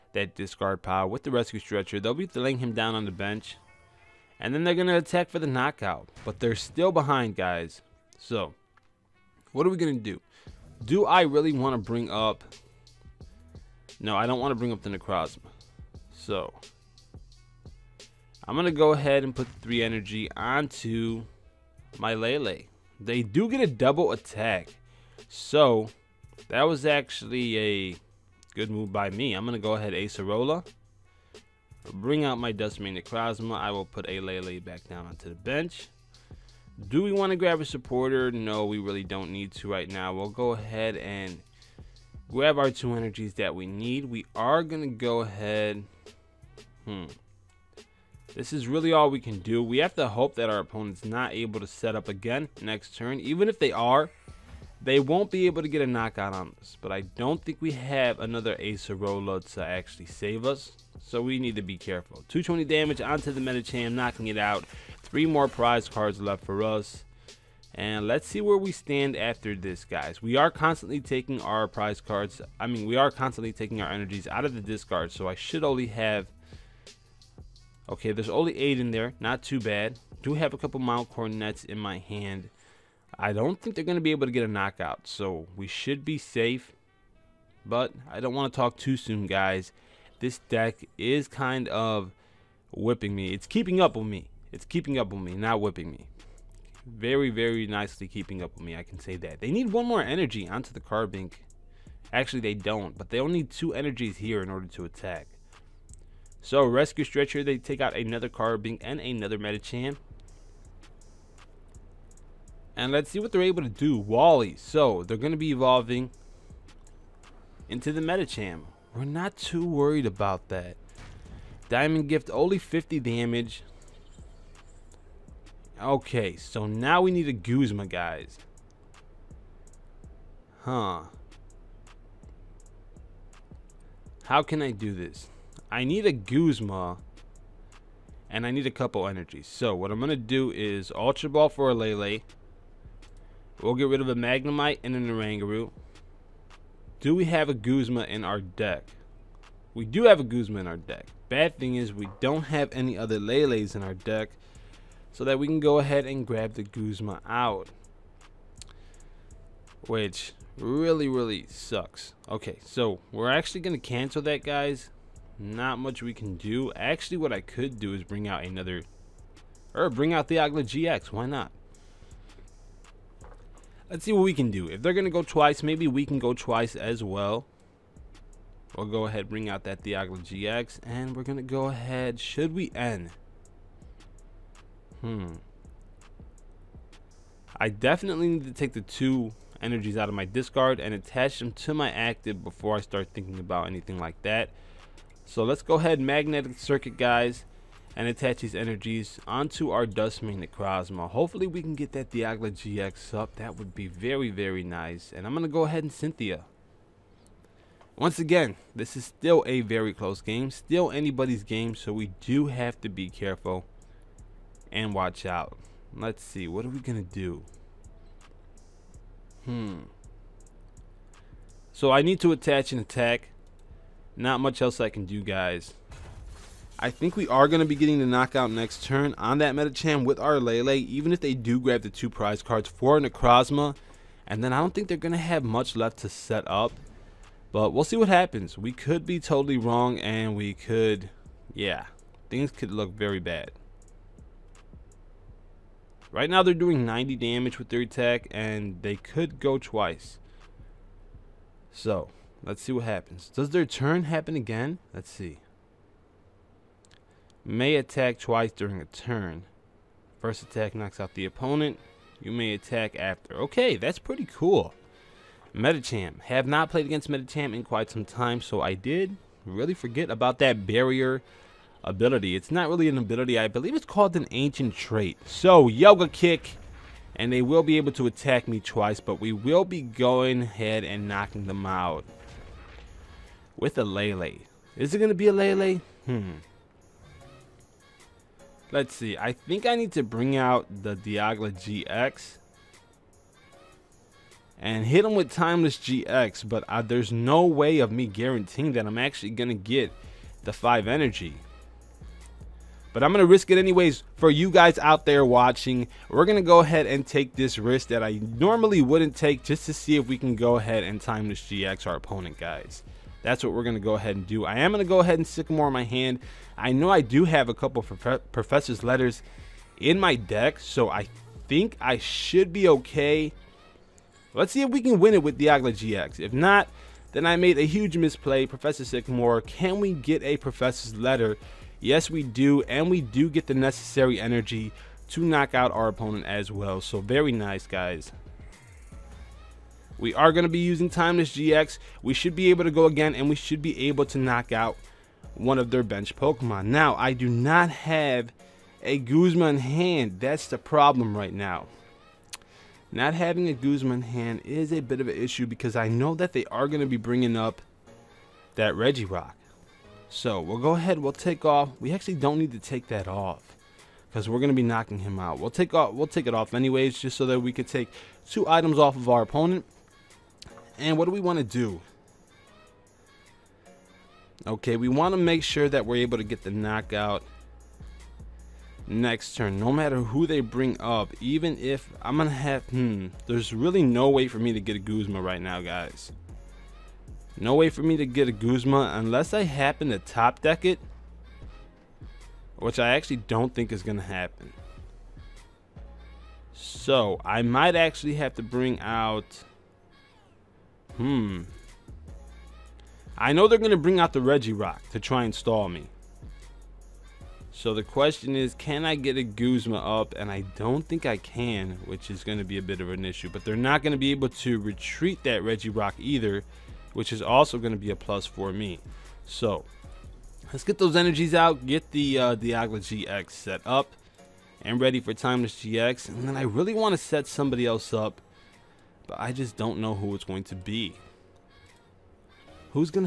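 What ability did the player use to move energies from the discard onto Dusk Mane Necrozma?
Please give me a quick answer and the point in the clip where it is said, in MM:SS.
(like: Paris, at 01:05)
Magnetic Circuit, at 03:15.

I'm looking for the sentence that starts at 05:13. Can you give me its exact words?
That's what we're going to go ahead and do.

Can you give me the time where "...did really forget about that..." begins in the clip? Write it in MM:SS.
04:28.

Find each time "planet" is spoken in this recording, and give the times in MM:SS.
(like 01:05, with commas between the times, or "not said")
not said.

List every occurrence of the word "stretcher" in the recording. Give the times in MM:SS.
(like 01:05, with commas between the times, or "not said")
00:01, 01:47.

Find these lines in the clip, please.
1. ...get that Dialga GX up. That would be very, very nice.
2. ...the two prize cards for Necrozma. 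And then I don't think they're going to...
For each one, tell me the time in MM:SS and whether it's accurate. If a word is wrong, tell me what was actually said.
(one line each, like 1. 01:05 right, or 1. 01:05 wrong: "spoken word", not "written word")
1. 03:21 right
2. 03:51 right.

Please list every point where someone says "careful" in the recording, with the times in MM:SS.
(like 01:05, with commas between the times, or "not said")
01:01, 03:33.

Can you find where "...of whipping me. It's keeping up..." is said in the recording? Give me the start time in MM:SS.
01:31.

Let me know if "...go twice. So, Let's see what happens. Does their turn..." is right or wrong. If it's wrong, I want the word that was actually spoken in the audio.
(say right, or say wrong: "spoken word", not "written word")
right.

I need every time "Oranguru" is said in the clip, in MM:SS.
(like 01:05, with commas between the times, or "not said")
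02:25.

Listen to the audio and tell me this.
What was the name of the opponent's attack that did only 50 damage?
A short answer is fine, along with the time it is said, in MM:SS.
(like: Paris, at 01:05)
Diamond Gift, at 02:01.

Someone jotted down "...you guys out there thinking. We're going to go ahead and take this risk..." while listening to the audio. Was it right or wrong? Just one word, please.
wrong.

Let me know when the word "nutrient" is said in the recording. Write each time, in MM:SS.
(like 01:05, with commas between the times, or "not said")
not said.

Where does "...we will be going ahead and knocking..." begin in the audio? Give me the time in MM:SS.
04:39.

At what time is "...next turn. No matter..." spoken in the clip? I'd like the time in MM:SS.
06:18.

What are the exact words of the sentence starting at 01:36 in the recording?
Very, very nicely keeping up with me, I can say that.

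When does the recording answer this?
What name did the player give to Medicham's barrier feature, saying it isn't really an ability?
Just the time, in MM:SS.
04:34.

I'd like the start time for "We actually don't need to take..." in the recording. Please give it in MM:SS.
06:01.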